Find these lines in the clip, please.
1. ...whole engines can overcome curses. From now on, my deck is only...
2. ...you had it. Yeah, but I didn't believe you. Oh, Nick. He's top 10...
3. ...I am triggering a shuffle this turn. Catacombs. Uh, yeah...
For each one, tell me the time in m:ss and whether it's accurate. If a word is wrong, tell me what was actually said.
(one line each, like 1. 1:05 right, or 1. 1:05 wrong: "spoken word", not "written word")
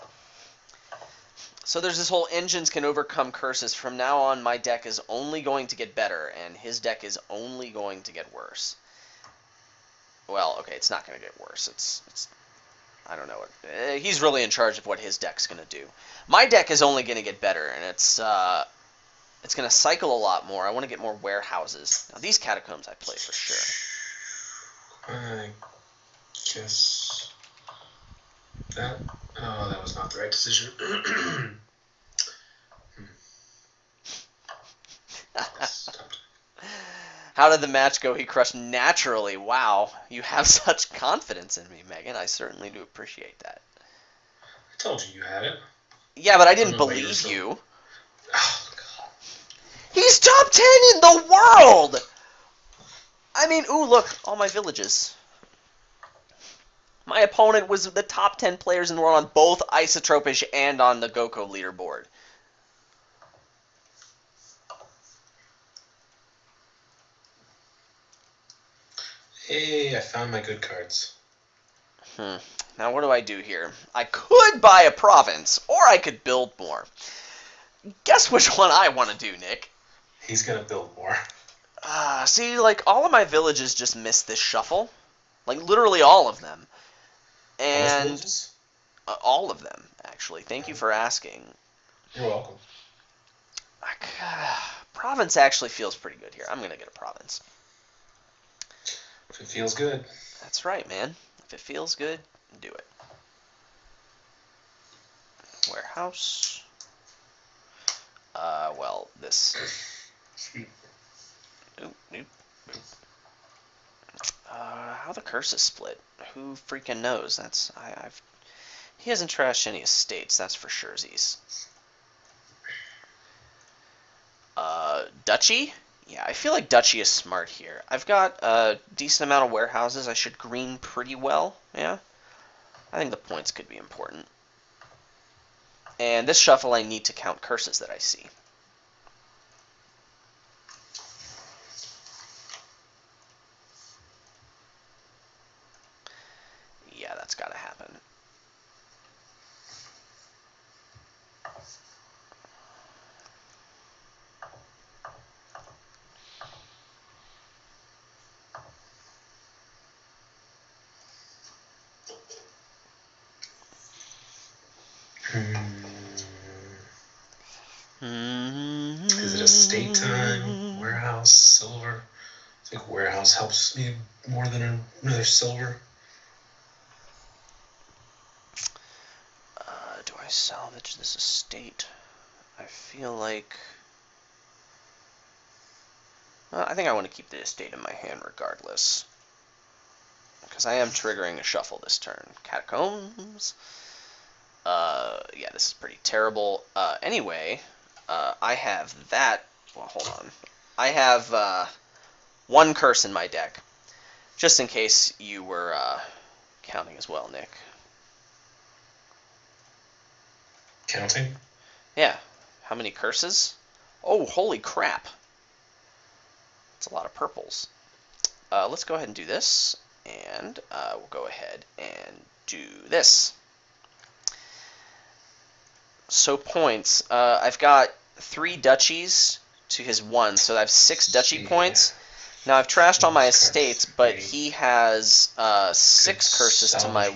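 1. 0:02 right
2. 0:45 wrong: "God", not "Nick"
3. 3:10 right.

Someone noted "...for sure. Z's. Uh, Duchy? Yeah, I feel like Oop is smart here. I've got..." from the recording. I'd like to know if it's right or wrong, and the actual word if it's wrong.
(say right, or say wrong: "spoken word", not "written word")
wrong: "Duchy", not "Oop".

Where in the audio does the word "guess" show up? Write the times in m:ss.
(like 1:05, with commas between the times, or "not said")
0:26, 1:18.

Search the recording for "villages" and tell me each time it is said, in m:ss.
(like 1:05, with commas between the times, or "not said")
0:54, 1:23.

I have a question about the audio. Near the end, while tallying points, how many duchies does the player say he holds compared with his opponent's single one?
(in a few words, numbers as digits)
3.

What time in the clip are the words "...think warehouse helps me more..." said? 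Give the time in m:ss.
2:52.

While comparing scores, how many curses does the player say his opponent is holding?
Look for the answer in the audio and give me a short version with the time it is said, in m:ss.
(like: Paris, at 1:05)
6, at 3:55.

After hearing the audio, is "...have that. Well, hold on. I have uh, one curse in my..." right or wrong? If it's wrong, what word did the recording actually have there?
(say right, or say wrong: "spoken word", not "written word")
right.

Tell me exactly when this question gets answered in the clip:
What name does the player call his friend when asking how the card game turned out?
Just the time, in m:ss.
0:41.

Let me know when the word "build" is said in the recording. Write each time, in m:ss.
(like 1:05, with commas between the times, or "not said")
1:16, 1:20.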